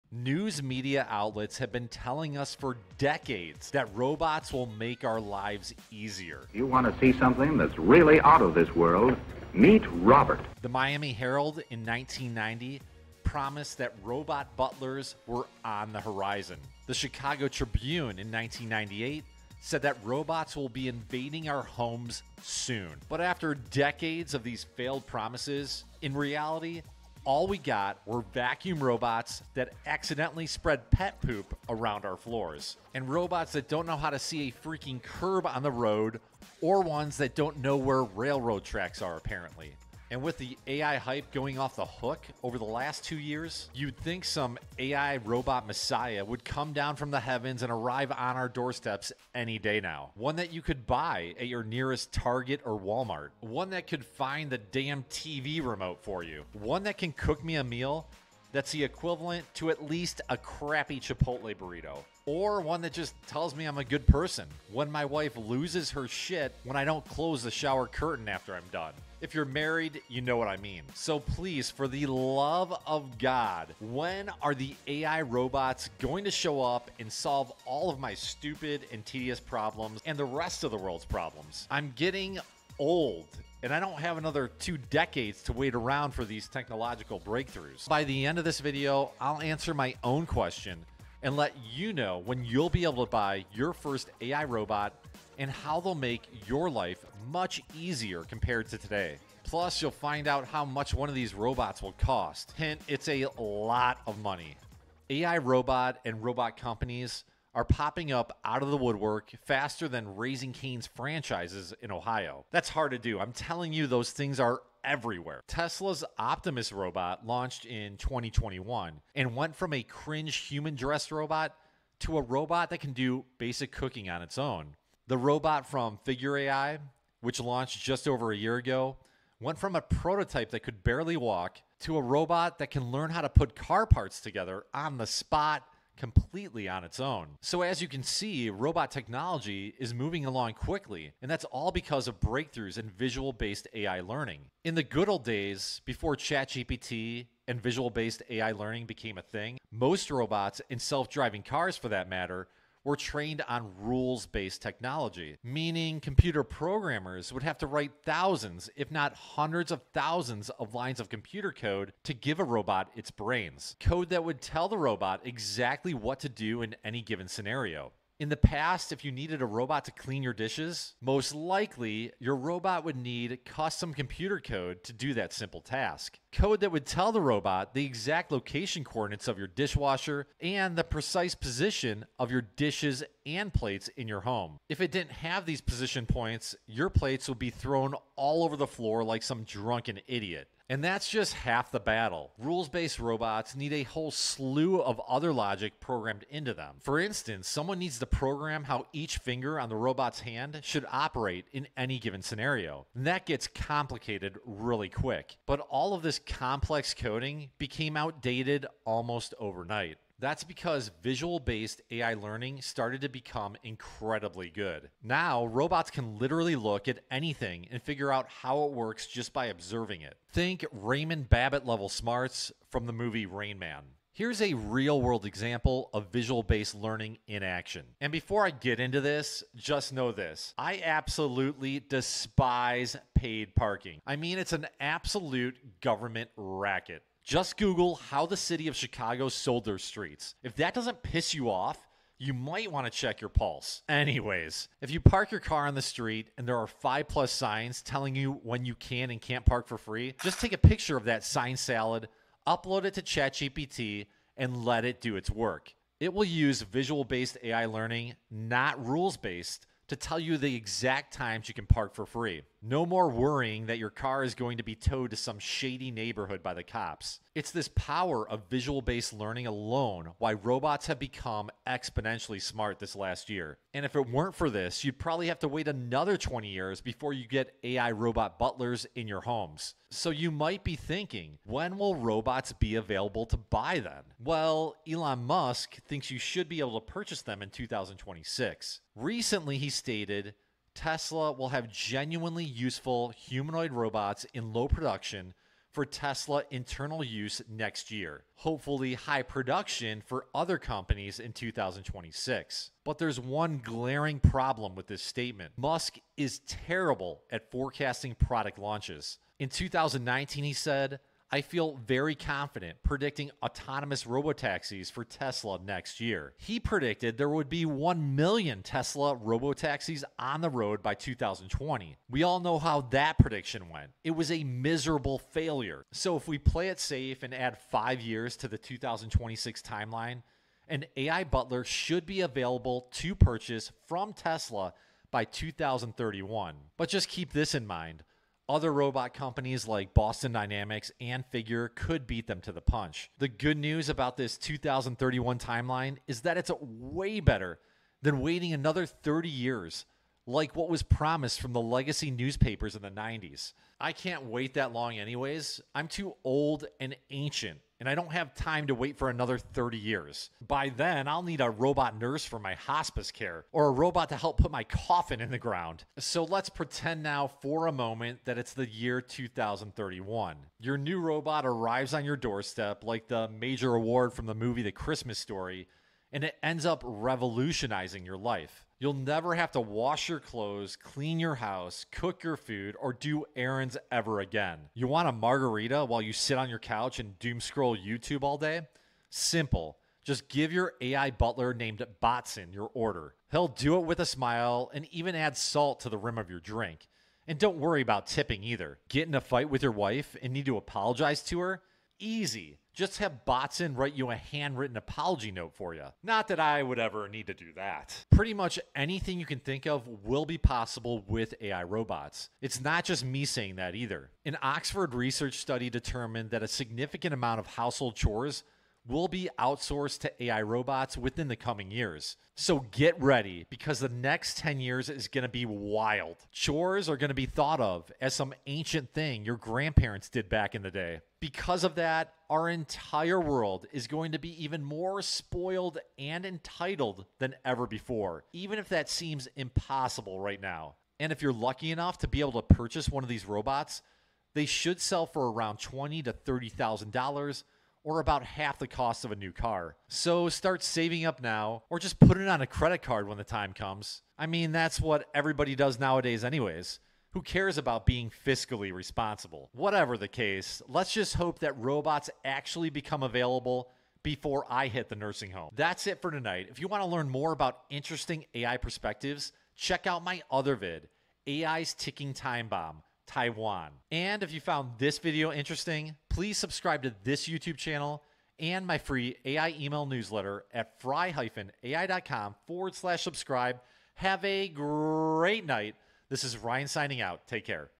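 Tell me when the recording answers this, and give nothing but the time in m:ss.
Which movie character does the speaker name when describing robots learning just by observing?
3:40.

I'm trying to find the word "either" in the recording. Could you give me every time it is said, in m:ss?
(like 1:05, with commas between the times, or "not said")
6:38, 6:53.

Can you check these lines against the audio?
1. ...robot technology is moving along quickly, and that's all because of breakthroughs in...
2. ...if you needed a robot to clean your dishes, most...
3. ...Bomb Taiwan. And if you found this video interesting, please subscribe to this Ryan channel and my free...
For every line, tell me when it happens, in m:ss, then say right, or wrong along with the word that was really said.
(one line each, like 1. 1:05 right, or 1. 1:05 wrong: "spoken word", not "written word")
1. 2:18 right
2. 2:48 right
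3. 7:52 wrong: "YouTube", not "Ryan".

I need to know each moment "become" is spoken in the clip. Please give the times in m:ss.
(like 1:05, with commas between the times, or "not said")
3:33, 4:30, 7:42.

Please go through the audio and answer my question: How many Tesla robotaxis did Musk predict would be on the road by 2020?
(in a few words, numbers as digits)
1 million.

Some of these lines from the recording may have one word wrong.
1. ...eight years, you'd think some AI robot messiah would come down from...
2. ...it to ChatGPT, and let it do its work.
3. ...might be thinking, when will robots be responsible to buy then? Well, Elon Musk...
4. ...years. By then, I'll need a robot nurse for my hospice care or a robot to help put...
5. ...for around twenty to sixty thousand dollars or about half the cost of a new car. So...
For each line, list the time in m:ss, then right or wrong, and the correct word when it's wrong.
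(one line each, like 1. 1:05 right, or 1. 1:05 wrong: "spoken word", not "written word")
1. 0:43 wrong: "two", not "eight"
2. 4:12 right
3. 4:40 wrong: "available", not "responsible"
4. 5:59 right
5. 7:25 wrong: "thirty", not "sixty".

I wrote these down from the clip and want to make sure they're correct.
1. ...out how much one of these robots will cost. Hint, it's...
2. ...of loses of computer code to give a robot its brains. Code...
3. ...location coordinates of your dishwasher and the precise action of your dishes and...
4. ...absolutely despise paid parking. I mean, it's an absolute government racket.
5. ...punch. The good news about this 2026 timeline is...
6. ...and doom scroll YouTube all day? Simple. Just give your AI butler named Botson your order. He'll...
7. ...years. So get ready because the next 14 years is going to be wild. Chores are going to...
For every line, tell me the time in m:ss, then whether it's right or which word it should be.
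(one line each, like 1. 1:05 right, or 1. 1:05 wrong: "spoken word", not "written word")
1. 1:40 right
2. 2:40 wrong: "lines", not "loses"
3. 2:58 wrong: "position", not "action"
4. 3:50 right
5. 5:42 wrong: "2031", not "2026"
6. 6:26 right
7. 7:01 wrong: "10", not "14".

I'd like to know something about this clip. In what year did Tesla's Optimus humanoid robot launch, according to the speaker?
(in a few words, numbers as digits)
2021.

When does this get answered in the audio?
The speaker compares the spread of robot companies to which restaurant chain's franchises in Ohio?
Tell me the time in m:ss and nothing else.
1:50.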